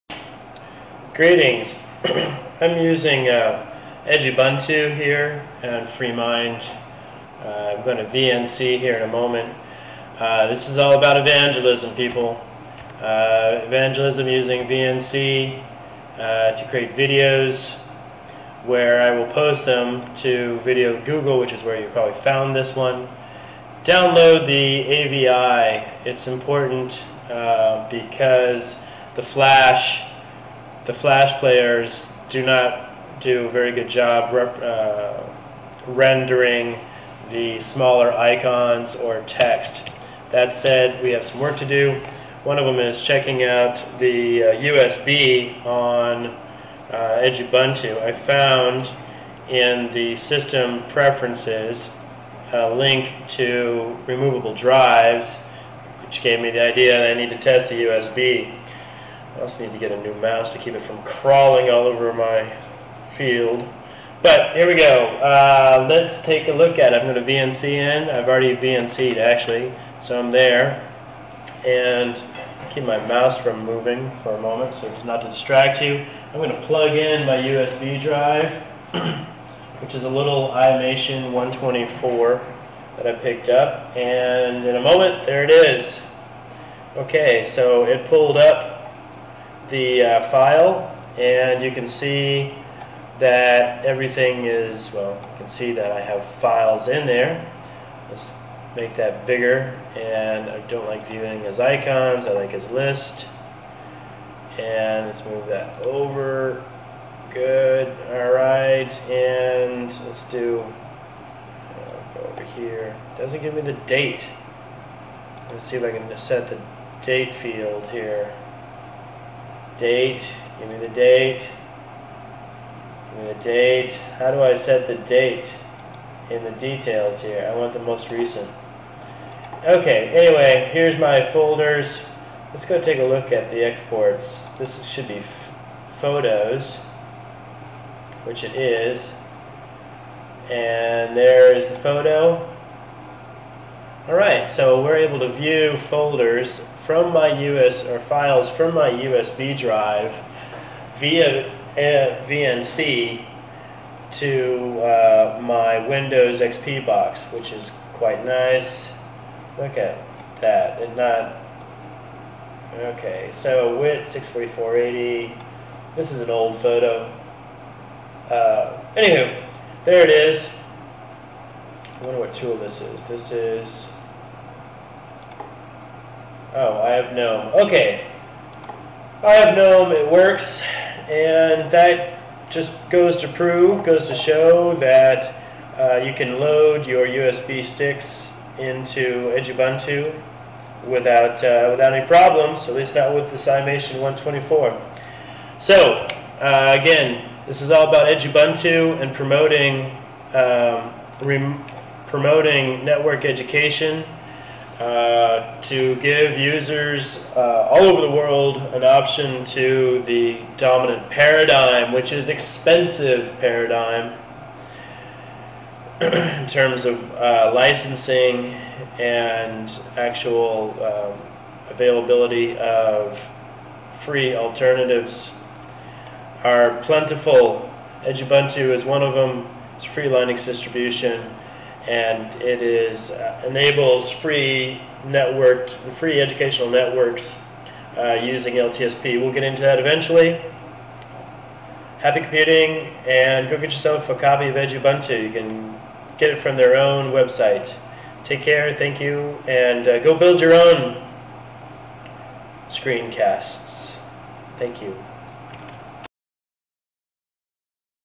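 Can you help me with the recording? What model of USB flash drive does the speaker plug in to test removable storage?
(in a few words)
iMation 124.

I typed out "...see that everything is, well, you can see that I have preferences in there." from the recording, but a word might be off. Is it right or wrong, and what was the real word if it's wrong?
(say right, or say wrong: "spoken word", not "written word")
wrong: "files", not "preferences".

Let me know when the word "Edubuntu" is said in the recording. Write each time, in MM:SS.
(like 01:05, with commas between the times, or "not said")
00:04, 00:47, 03:48, 04:04.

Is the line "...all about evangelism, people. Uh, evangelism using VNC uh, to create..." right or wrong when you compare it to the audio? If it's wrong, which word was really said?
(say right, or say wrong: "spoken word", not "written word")
right.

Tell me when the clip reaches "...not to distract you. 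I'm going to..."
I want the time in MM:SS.
01:15.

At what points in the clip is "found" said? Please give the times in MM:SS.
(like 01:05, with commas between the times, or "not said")
00:22, 00:48.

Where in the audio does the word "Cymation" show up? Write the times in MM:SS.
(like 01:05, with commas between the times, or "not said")
03:13.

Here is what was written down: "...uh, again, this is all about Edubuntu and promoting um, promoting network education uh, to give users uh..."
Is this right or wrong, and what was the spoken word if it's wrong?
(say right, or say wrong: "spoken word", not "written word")
wrong: "Ubuntu", not "Edubuntu".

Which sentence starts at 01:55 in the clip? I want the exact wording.
Let's see if I can set the date field here date.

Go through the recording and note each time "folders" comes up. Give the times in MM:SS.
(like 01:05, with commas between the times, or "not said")
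02:11, 02:25.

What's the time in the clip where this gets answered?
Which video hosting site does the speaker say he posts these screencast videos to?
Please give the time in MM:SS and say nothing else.
00:20.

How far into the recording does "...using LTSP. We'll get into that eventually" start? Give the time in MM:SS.
03:58.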